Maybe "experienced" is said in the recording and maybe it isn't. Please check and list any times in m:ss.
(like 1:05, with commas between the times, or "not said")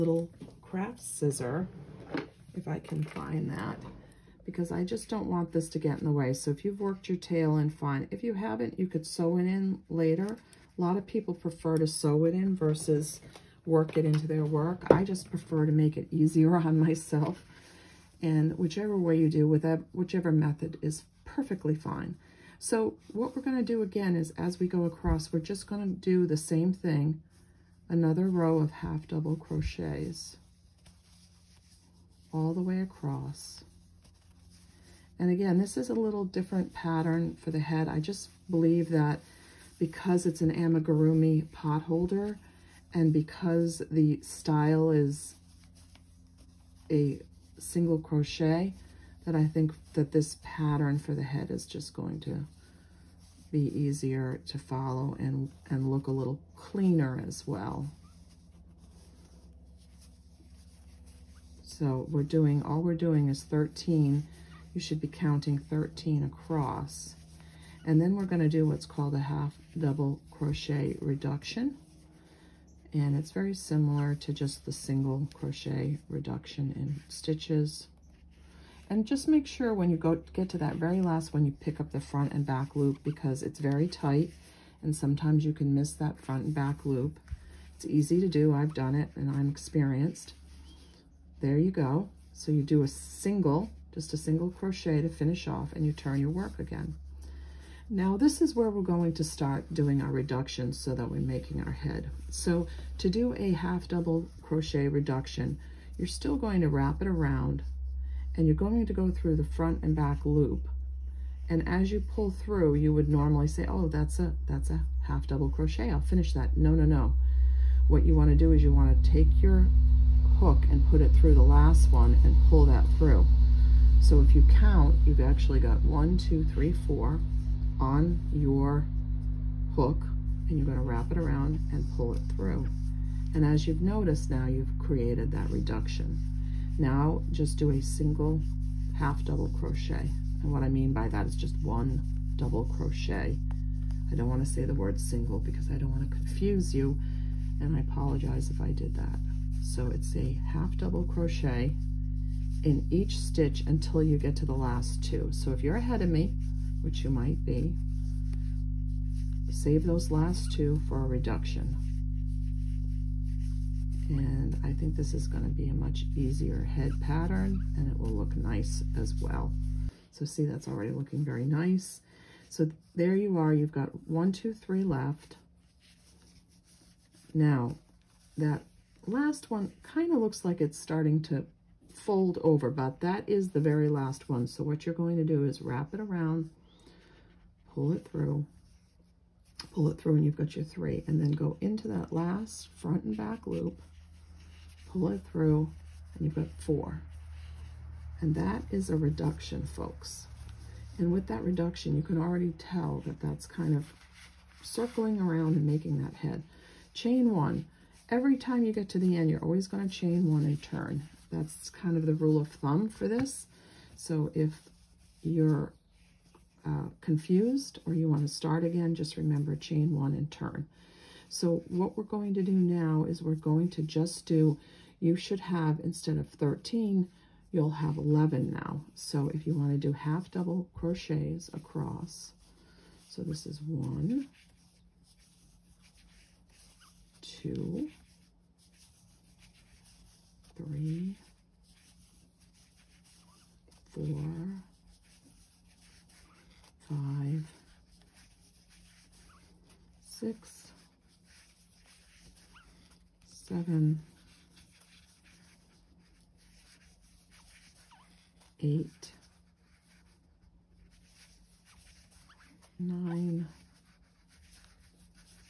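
1:29.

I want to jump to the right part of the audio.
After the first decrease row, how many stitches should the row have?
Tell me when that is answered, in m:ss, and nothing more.
3:47.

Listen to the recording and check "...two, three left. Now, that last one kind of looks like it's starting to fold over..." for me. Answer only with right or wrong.
right.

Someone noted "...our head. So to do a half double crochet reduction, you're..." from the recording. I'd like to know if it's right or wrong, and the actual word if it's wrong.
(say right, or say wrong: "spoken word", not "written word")
right.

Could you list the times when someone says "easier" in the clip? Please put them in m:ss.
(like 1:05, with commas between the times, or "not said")
0:16, 0:53, 2:46.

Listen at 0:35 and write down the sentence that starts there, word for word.
And again, this is a little different pattern for the head.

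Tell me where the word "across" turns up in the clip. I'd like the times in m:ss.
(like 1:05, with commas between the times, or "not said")
0:24, 0:32, 1:06, 3:51.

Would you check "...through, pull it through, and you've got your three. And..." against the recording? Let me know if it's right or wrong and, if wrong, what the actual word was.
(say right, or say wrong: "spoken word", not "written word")
right.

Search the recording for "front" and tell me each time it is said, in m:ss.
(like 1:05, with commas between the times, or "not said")
1:22, 1:26, 1:49, 3:12.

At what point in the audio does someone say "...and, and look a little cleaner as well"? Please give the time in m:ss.
0:55.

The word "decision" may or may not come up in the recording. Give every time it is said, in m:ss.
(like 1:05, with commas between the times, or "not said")
not said.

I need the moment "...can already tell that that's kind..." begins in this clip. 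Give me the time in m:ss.
3:22.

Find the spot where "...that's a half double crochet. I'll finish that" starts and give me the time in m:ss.
1:54.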